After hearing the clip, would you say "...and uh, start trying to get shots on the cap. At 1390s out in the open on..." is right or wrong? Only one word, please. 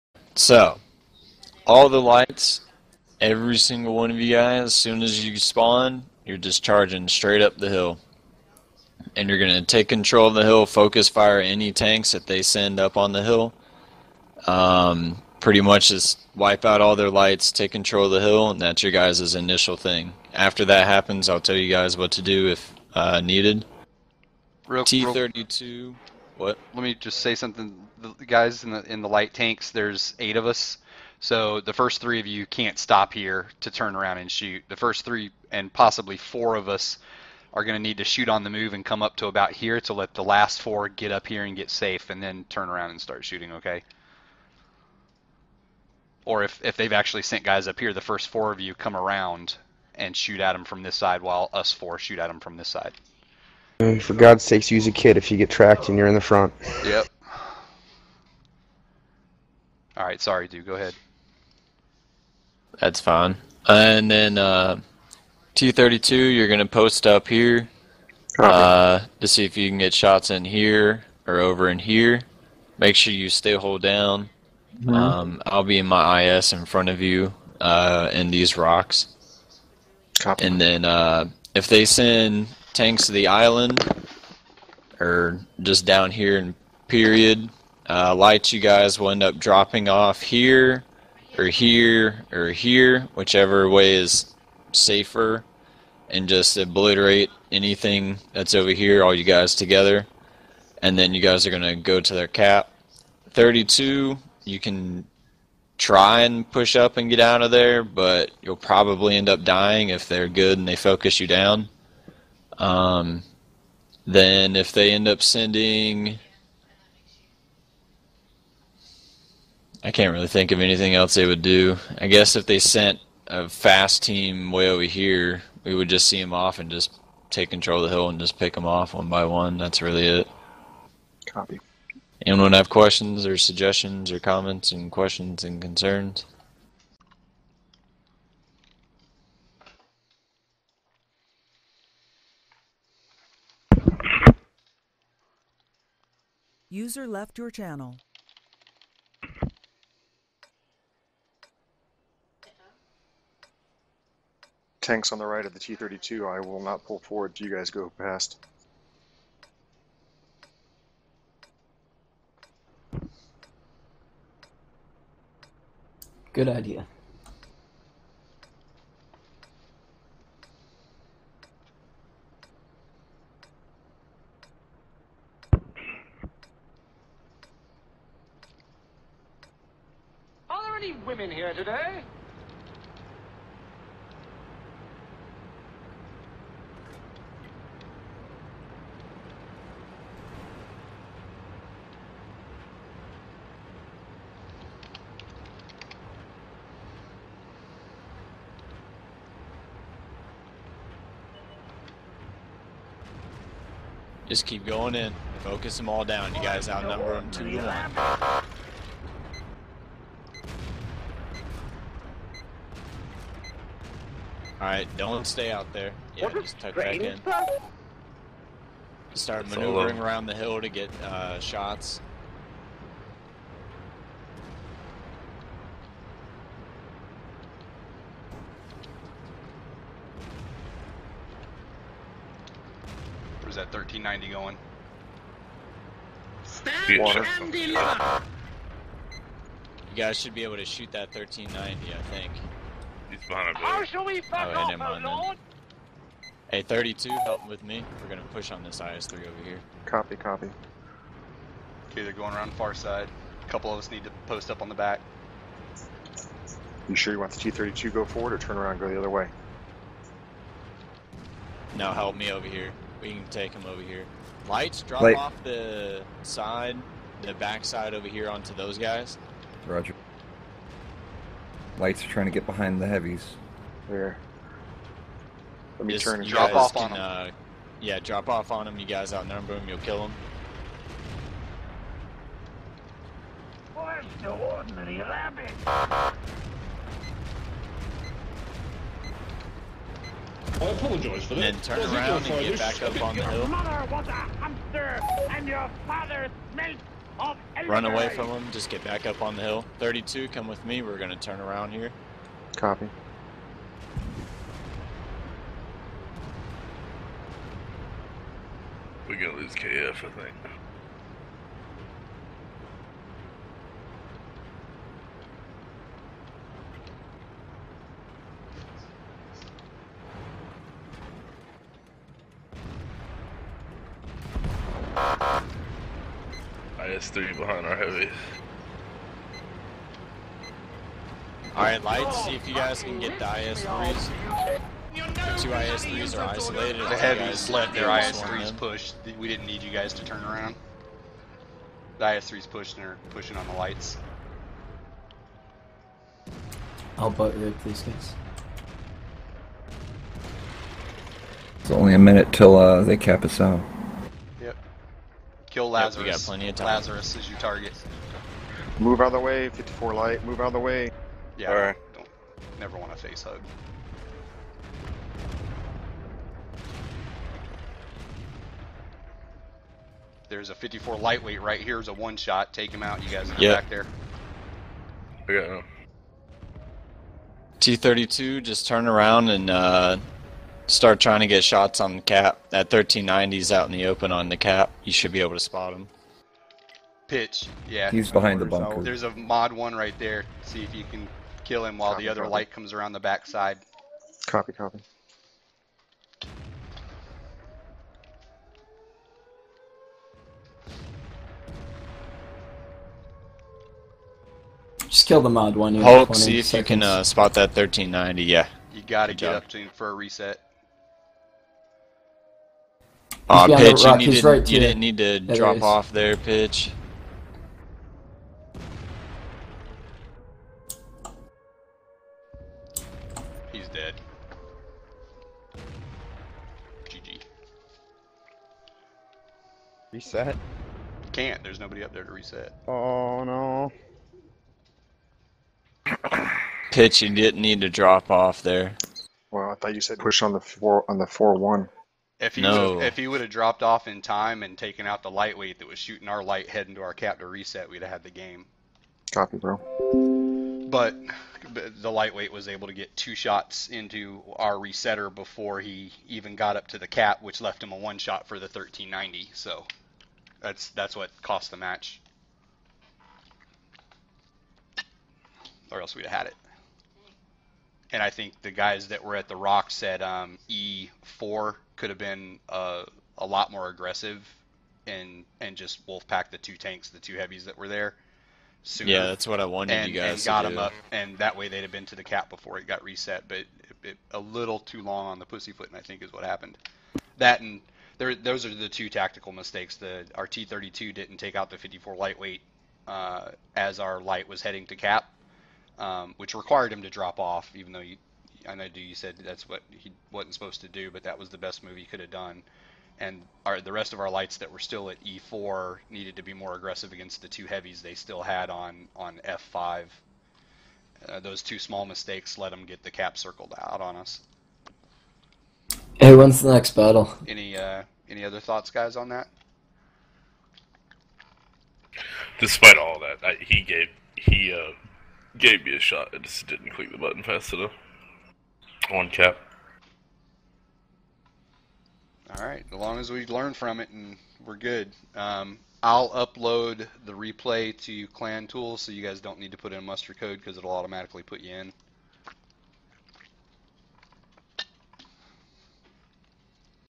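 right.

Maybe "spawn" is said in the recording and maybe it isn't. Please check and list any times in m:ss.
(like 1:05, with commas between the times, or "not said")
0:05.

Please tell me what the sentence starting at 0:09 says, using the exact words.
And you're going to take control of the hill, focus fire any tanks that they send up on the hill.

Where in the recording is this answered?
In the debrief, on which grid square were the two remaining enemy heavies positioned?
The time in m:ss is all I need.
8:29.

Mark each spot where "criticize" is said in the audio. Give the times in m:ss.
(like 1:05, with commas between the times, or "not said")
not said.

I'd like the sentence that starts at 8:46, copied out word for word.
I just didn't click the button fast enough.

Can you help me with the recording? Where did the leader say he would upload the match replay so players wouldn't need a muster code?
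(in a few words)
Clan Tools.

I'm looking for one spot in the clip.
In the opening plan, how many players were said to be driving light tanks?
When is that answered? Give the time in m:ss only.
0:29.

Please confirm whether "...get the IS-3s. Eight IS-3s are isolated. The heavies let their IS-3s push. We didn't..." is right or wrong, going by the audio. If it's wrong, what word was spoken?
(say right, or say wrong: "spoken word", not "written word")
wrong: "Two", not "Eight".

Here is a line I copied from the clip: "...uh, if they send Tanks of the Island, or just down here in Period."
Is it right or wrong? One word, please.
right.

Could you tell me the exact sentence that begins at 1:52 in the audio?
Um, then if they end up sending, I can't really think of anything else they would do.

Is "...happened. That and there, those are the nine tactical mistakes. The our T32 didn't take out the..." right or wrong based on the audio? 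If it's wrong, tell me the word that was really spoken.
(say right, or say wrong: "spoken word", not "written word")
wrong: "two", not "nine".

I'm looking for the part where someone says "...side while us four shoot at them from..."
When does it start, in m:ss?
0:50.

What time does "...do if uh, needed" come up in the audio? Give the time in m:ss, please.
0:22.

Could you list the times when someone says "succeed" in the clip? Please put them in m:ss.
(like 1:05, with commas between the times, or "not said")
not said.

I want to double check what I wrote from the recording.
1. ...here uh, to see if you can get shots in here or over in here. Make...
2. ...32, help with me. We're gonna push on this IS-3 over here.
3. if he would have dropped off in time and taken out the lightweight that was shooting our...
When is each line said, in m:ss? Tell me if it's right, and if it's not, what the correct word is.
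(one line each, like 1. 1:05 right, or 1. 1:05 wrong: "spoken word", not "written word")
1. 1:07 right
2. 4:06 right
3. 7:22 right.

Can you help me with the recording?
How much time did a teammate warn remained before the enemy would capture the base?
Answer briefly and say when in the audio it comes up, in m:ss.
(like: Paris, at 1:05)
A minute, at 5:51.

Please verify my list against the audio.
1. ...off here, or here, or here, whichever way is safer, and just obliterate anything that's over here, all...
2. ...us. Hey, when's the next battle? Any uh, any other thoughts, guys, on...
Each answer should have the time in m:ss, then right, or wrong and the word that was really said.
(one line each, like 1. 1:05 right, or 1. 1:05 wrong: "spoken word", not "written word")
1. 1:29 right
2. 8:33 right.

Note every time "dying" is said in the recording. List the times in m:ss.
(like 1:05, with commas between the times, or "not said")
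1:49.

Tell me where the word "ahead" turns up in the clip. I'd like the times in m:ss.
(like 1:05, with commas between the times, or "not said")
1:00.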